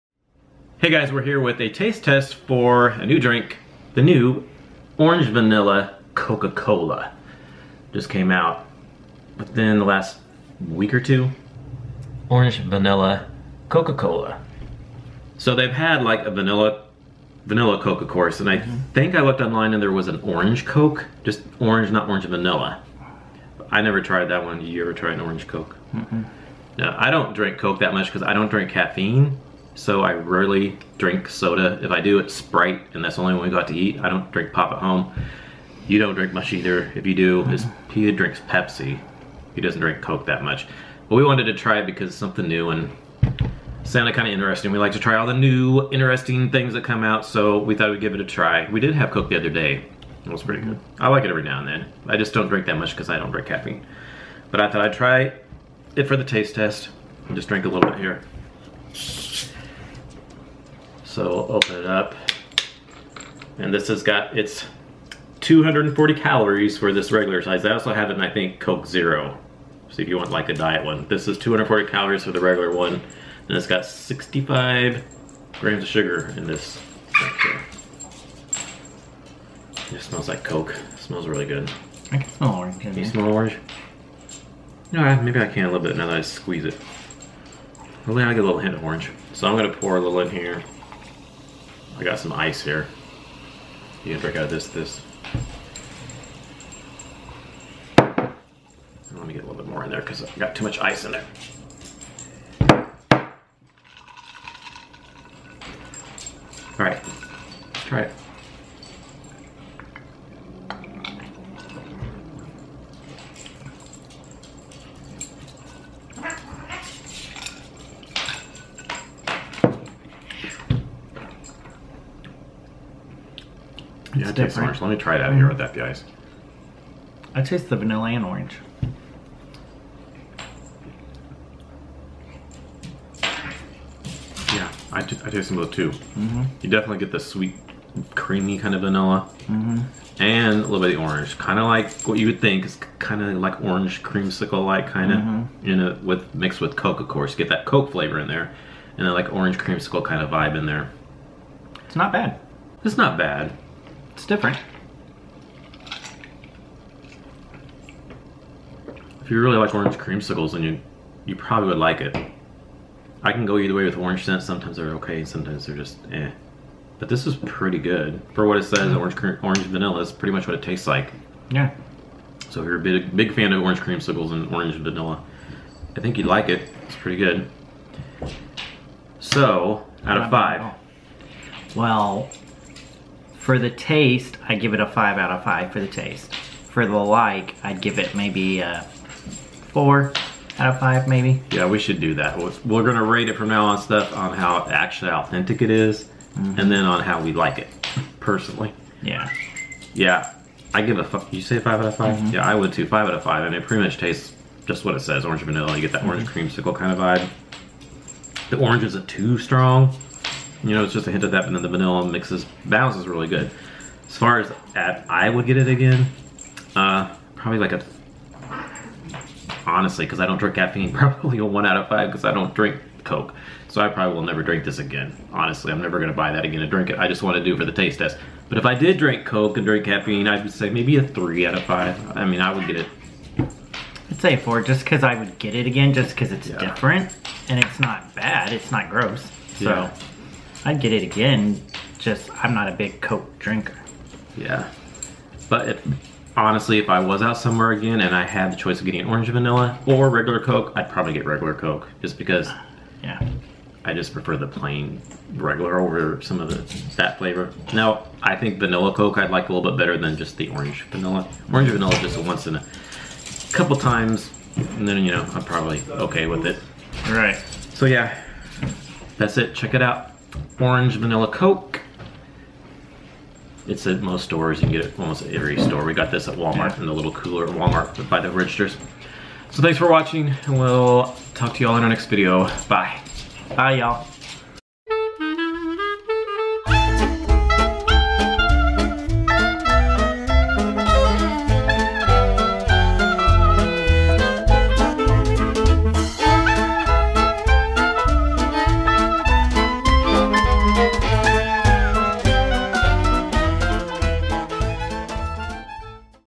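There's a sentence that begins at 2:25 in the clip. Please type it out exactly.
you know, with mixed with Coke, of course.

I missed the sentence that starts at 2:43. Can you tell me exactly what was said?
I can go either way with orange scent.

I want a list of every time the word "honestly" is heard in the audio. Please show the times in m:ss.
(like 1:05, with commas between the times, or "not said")
3:39, 3:45, 4:06.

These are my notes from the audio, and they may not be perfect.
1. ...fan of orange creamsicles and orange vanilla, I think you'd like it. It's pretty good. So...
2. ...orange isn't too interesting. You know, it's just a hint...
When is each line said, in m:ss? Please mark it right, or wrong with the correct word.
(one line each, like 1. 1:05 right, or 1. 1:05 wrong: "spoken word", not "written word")
1. 2:53 right
2. 3:28 wrong: "strong", not "interesting".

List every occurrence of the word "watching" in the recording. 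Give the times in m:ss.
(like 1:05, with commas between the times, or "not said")
4:39.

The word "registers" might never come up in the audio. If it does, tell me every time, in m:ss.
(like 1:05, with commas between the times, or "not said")
4:38.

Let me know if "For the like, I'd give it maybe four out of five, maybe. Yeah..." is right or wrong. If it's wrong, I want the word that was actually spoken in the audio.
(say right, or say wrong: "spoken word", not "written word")
right.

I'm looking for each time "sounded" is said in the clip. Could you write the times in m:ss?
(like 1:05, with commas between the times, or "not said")
0:43.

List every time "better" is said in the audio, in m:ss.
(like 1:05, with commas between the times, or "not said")
4:19.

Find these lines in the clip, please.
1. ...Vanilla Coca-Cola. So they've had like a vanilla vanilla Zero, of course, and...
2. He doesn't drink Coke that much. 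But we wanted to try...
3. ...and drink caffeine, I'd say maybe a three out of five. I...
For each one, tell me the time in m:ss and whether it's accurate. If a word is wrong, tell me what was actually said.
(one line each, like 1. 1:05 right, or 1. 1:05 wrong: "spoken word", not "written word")
1. 0:12 wrong: "Coke", not "Zero"
2. 0:39 right
3. 3:49 right.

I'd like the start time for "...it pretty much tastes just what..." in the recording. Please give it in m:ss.
3:23.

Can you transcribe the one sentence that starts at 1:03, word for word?
And this has got, it's 240 calories for this regular size.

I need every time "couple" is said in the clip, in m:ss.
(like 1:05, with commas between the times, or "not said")
4:23.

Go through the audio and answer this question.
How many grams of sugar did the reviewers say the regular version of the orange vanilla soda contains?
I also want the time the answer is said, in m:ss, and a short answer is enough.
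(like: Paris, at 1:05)
65, at 1:13.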